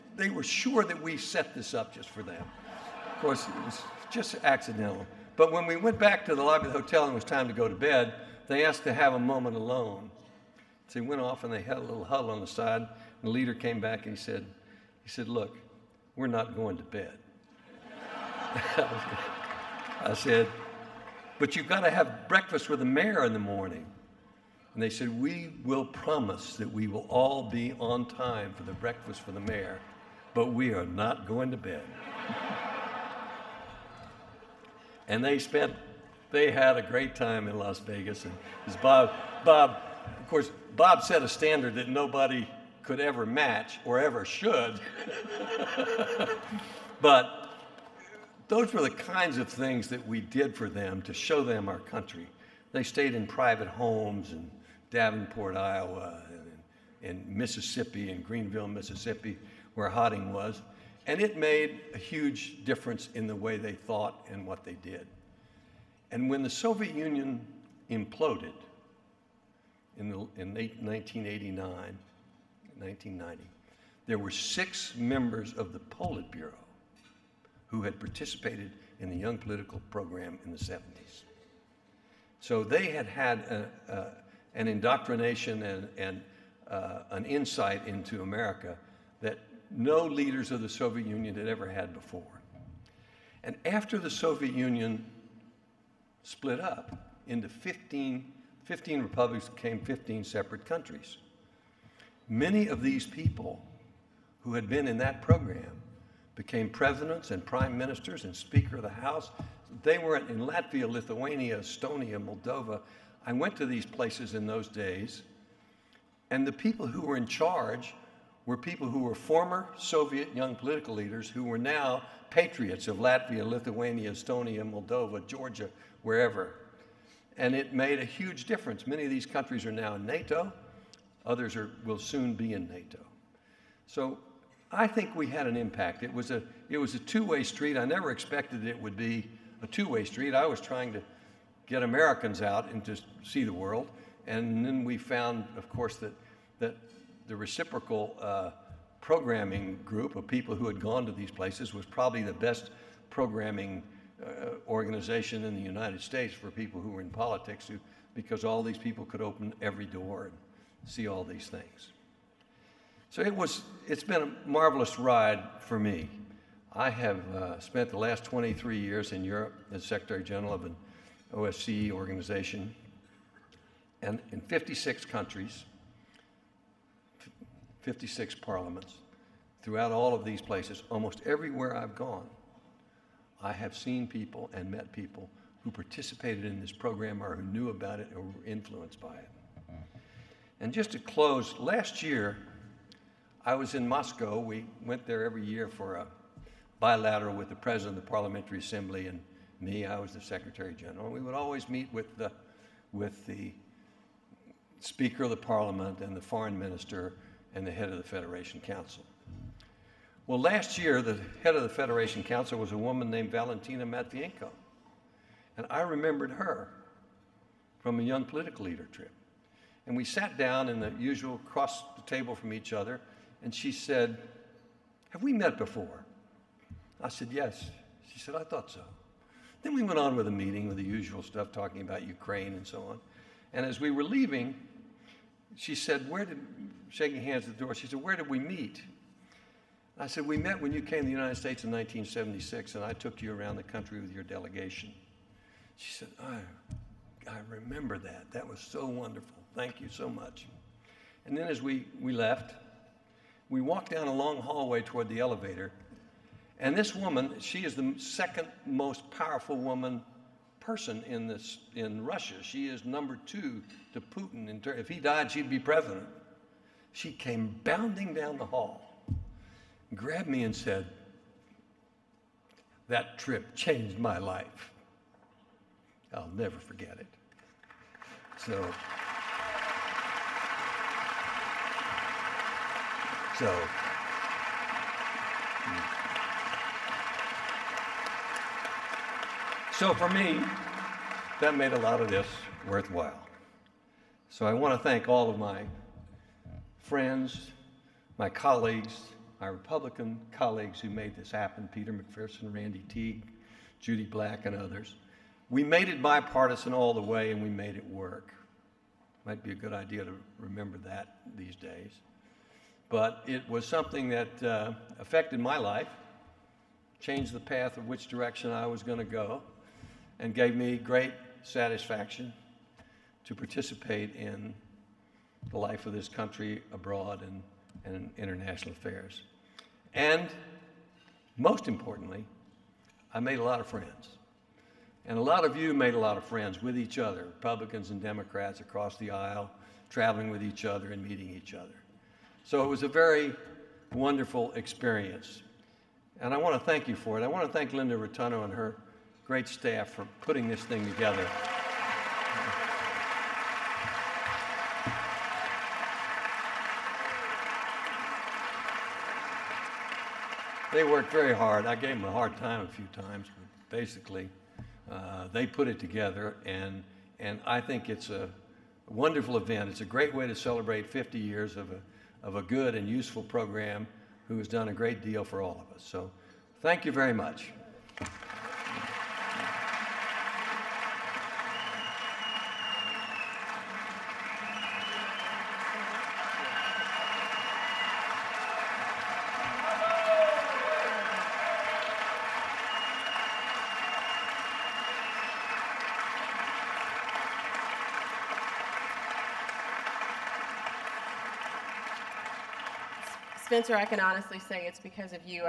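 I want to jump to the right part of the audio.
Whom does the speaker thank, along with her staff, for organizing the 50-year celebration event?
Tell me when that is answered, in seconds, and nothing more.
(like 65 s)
347 s.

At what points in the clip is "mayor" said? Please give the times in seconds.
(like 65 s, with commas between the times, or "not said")
22 s, 29 s.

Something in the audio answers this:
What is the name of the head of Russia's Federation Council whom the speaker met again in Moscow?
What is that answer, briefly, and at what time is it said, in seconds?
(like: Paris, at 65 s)
Valentina Matvienko, at 213 s.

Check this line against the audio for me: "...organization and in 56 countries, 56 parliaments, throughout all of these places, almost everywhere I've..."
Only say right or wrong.
right.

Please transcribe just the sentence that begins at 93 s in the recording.
And after the Soviet Union split up into 15, 15 republics, became 15 separate countries.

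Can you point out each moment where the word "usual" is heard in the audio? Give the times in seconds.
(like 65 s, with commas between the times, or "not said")
220 s, 230 s.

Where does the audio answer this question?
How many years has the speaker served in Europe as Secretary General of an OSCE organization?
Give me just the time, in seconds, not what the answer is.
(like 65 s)
168 s.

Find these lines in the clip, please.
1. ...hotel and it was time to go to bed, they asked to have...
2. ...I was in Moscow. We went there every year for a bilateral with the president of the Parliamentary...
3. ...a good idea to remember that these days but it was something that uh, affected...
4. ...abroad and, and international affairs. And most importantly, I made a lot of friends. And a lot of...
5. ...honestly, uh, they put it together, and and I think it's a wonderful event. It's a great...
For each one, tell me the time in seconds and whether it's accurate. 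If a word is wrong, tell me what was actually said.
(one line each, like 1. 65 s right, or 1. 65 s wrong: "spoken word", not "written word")
1. 6 s right
2. 193 s right
3. 309 s right
4. 326 s right
5. 363 s wrong: "basically", not "honestly".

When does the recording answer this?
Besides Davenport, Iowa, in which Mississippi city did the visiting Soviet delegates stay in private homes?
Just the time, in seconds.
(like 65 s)
58 s.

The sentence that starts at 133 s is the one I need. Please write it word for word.
So I think we had an impact.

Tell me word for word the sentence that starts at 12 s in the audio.
And the leader came back and he said, he said, look, we're not going to bed.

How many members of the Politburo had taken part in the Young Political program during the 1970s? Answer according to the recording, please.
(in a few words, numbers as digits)
6.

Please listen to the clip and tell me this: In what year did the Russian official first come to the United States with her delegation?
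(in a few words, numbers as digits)
1976.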